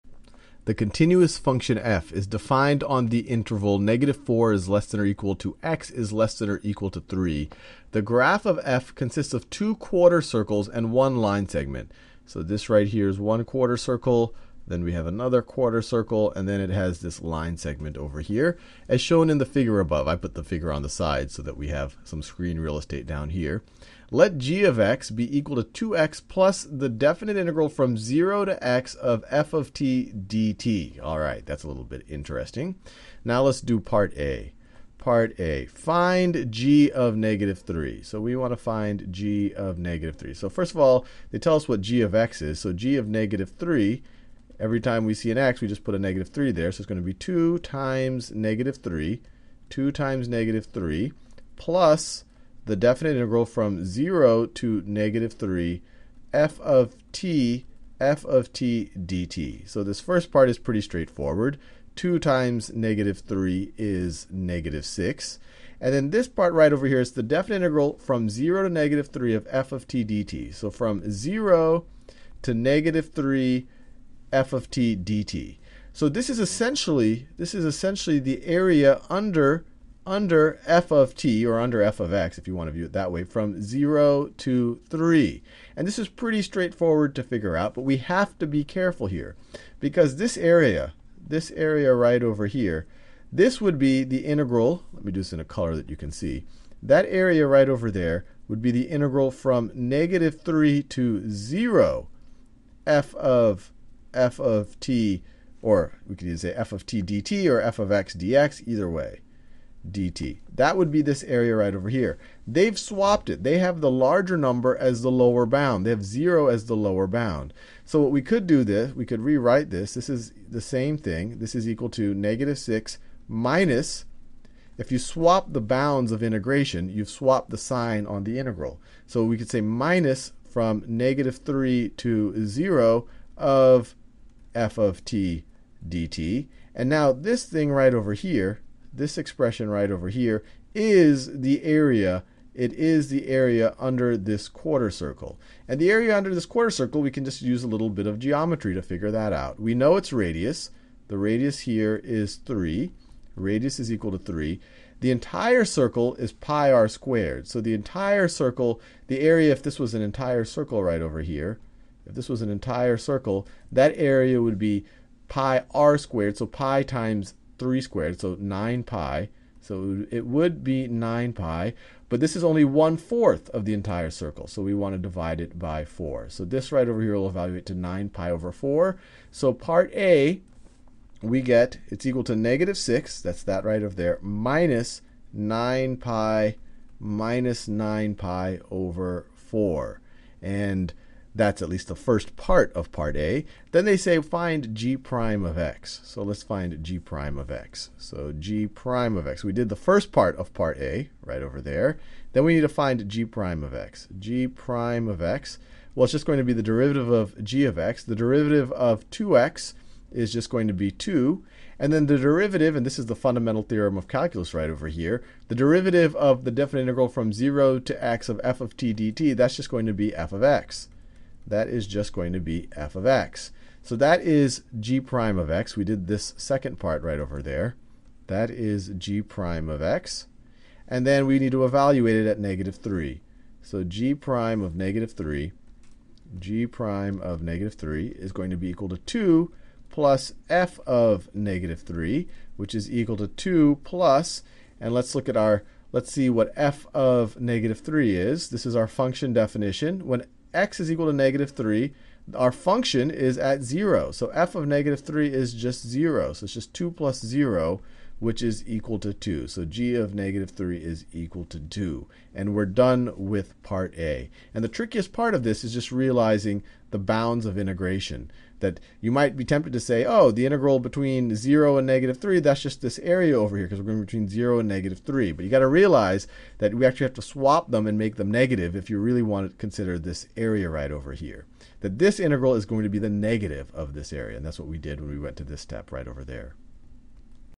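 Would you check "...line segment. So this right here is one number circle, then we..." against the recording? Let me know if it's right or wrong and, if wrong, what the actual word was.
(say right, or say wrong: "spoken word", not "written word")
wrong: "quarter", not "number".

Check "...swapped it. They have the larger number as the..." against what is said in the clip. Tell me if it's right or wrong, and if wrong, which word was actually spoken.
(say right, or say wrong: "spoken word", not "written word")
right.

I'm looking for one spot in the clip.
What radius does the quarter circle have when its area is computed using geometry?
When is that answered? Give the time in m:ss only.
2:33.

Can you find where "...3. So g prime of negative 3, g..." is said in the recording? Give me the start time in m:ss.
3:52.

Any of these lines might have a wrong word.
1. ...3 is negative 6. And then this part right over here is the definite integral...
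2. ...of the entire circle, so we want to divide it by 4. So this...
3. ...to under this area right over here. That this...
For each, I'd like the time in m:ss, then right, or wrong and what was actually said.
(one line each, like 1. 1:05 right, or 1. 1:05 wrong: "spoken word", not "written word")
1. 1:03 right
2. 2:53 right
3. 4:39 wrong: "consider", not "under".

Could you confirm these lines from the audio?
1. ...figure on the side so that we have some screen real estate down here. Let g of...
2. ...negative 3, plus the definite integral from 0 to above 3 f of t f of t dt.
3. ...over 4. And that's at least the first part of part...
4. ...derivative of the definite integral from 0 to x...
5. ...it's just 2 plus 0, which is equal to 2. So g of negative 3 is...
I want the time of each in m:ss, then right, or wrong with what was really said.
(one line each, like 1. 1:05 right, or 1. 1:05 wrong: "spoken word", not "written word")
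1. 0:20 right
2. 0:50 wrong: "negative", not "above"
3. 3:08 right
4. 3:35 right
5. 4:16 right.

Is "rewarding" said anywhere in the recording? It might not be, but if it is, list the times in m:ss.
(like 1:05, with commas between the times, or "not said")
not said.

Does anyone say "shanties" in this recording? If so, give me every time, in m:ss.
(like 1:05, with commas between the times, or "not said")
not said.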